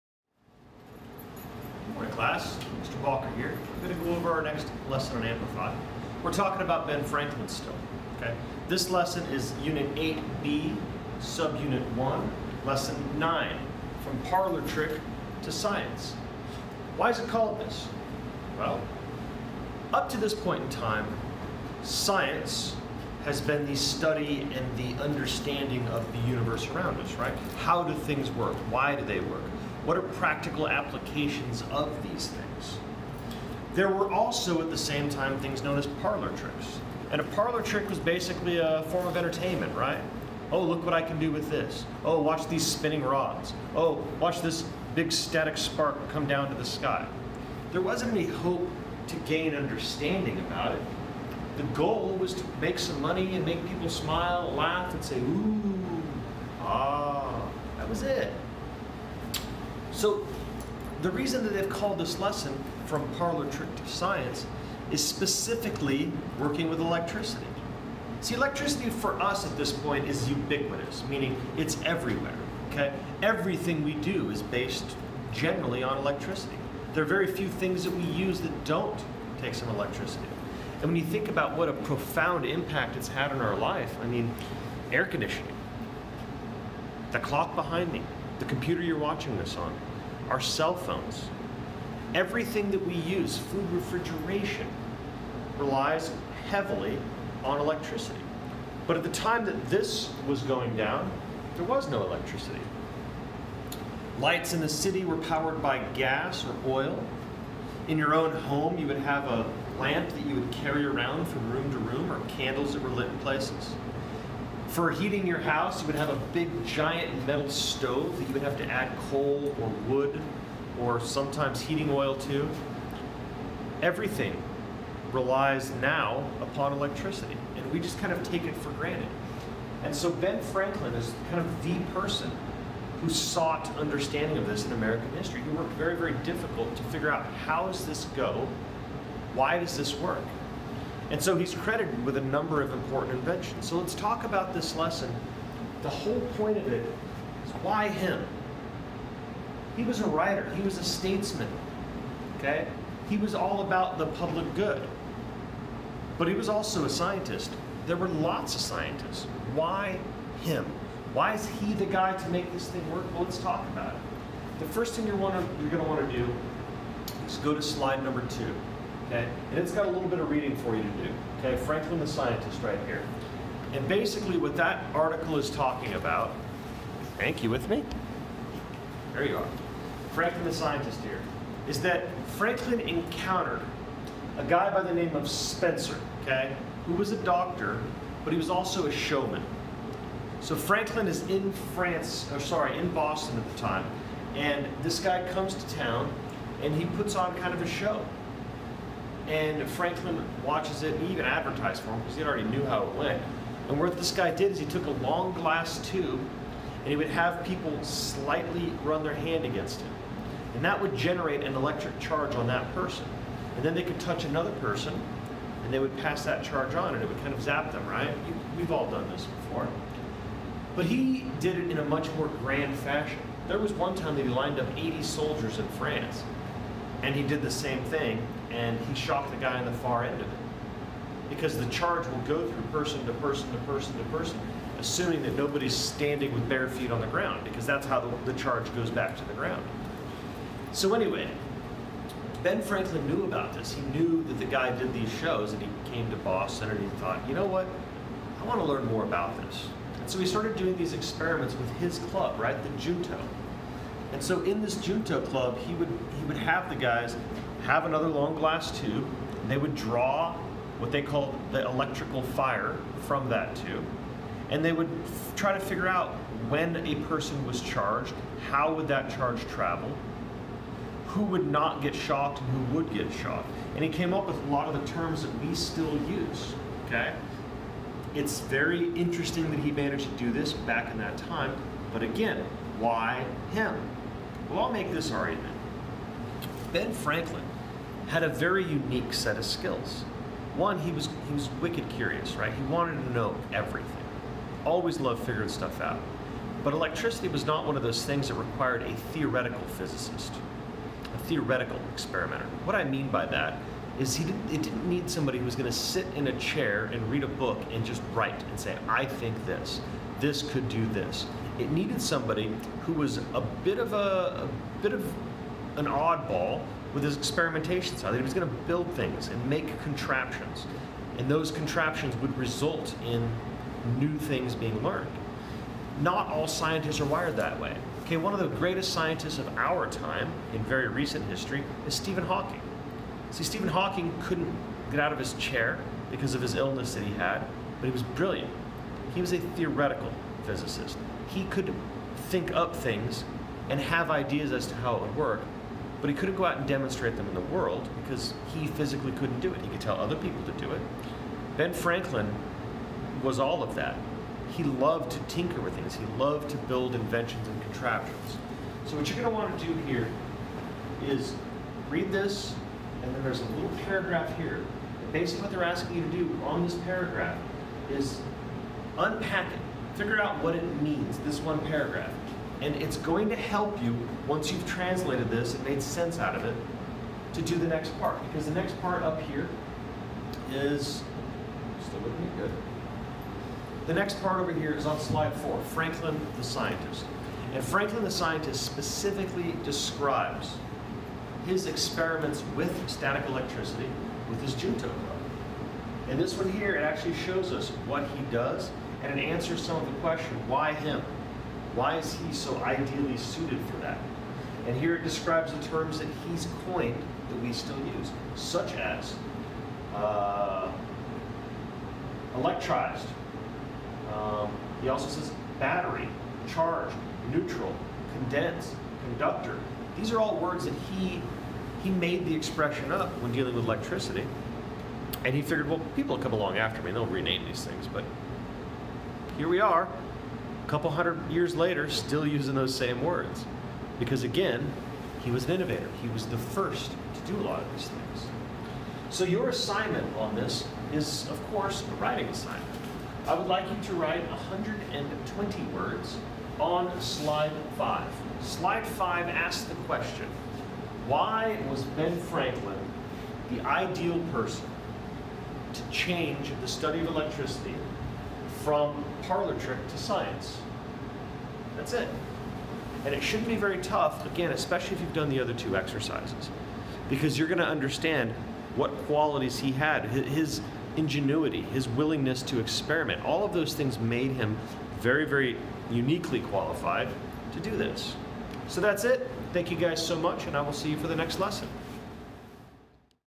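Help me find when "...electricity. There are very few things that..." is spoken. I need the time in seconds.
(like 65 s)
75 s.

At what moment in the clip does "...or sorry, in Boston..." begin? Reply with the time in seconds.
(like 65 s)
192 s.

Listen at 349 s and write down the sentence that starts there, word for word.
He could tell other people to do it.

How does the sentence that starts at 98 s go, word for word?
But at the time that this was going down, there was no electricity.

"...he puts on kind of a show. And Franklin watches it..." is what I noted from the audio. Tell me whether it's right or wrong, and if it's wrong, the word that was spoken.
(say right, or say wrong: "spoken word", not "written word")
right.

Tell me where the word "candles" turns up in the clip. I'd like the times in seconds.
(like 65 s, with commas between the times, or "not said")
112 s.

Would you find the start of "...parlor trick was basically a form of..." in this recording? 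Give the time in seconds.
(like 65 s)
37 s.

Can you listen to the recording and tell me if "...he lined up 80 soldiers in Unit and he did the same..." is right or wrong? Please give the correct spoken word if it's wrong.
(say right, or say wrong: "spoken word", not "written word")
wrong: "France", not "Unit".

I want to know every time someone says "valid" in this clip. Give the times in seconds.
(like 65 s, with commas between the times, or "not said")
not said.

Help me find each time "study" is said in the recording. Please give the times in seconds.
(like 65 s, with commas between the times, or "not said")
23 s, 456 s.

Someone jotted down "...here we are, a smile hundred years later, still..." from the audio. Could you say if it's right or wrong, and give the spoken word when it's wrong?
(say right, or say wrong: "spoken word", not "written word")
wrong: "couple", not "smile".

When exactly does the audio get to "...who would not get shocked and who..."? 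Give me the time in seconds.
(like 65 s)
271 s.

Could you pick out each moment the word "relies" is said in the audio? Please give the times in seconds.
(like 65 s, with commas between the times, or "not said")
95 s, 125 s.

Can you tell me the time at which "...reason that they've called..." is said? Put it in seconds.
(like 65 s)
61 s.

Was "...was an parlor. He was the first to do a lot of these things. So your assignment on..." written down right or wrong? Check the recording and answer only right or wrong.
wrong.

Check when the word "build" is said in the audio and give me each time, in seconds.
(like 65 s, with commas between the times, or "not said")
318 s, 356 s.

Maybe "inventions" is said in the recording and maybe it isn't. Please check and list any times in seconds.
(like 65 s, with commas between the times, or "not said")
143 s, 356 s.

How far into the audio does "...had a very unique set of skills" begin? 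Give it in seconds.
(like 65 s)
288 s.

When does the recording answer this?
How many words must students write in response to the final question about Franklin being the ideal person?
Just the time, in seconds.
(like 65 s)
444 s.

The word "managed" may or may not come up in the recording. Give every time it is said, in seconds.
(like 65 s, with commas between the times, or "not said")
279 s.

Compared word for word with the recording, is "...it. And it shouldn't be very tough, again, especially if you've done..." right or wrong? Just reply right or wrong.
right.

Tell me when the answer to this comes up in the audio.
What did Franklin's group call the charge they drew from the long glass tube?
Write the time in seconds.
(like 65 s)
261 s.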